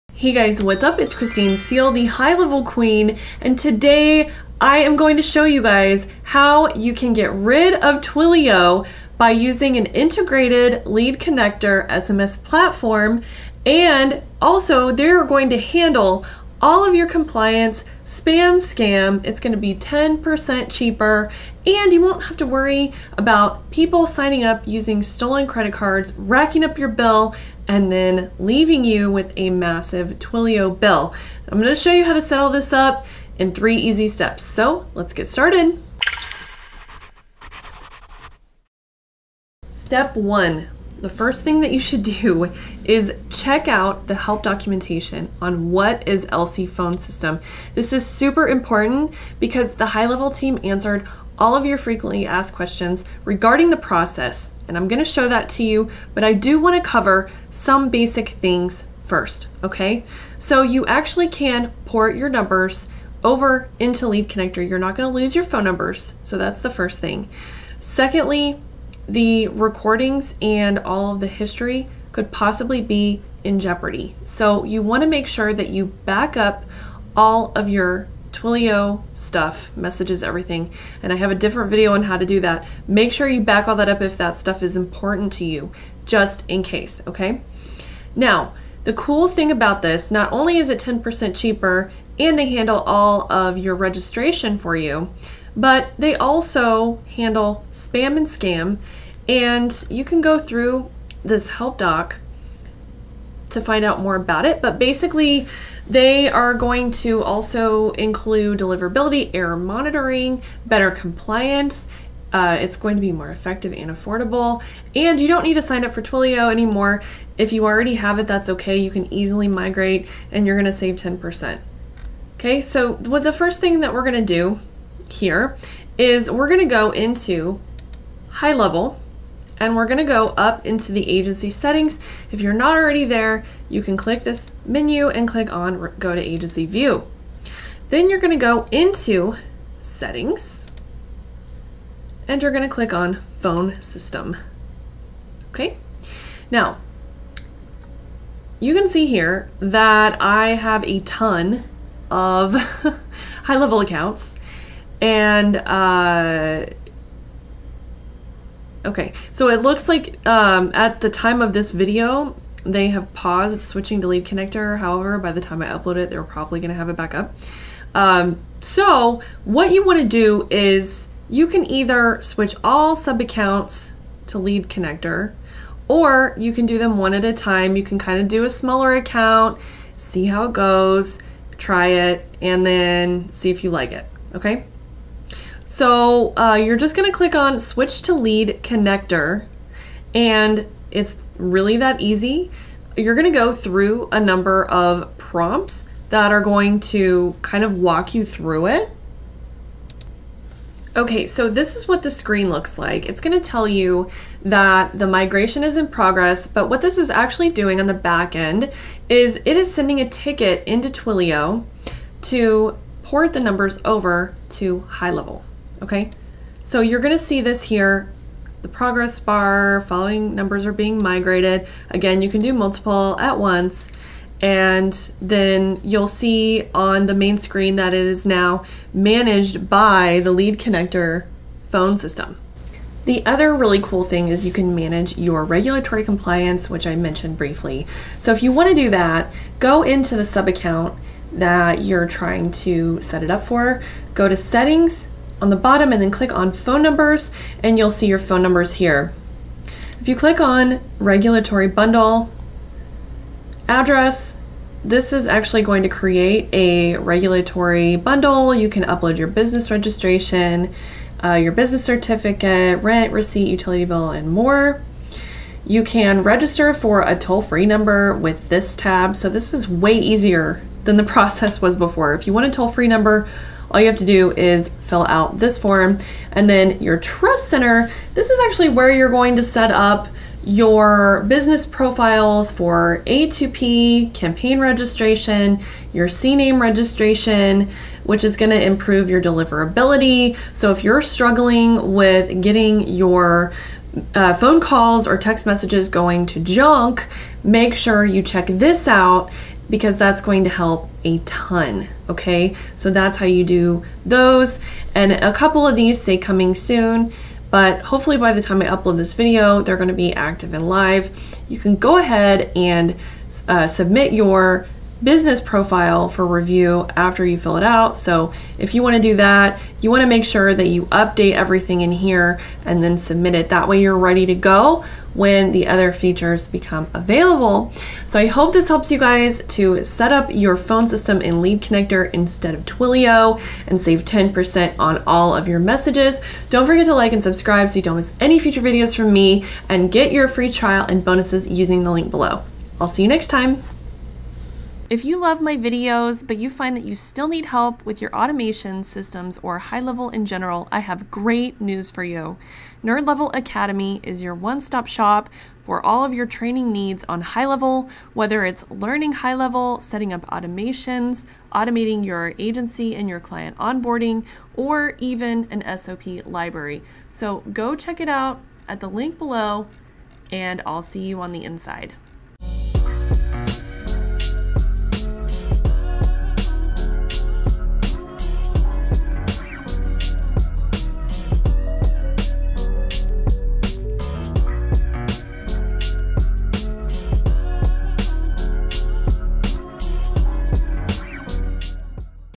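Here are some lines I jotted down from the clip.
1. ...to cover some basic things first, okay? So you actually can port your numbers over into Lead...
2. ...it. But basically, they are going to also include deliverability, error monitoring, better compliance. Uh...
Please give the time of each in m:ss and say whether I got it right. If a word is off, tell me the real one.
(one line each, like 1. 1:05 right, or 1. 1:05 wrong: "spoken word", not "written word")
1. 0:56 right
2. 1:44 right.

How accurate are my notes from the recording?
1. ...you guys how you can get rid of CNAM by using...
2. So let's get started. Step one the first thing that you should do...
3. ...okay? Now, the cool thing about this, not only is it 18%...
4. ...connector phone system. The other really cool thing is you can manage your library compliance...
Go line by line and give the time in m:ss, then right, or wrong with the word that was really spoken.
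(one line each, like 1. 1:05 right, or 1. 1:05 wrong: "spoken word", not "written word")
1. 0:05 wrong: "Twilio", not "CNAM"
2. 0:34 right
3. 1:27 wrong: "10", not "18"
4. 3:50 wrong: "regulatory", not "library".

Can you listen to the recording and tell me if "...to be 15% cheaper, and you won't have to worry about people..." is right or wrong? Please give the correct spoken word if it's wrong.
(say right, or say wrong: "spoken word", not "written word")
wrong: "10", not "15".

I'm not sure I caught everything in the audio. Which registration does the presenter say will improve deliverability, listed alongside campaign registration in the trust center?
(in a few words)
CNAM registration.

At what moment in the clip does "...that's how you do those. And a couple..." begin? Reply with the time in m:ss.
5:02.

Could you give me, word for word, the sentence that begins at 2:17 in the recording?
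Then you're going to go into settings and you're going to click on phone system.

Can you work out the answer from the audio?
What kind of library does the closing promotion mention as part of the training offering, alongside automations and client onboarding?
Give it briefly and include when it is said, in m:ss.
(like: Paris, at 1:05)
SOP library, at 6:05.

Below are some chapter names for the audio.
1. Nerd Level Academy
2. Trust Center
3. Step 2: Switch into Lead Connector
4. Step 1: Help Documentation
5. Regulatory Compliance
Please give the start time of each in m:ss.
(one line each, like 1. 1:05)
1. 5:43
2. 4:35
3. 2:02
4. 0:39
5. 3:52.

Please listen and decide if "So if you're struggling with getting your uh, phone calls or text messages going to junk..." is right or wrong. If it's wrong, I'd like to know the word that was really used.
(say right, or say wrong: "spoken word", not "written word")
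right.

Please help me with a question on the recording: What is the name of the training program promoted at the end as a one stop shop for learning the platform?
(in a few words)
Nerd Level Academy.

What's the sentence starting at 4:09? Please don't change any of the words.
If you click on regulatory bundle, address, this is actually going to create a regulatory bundle.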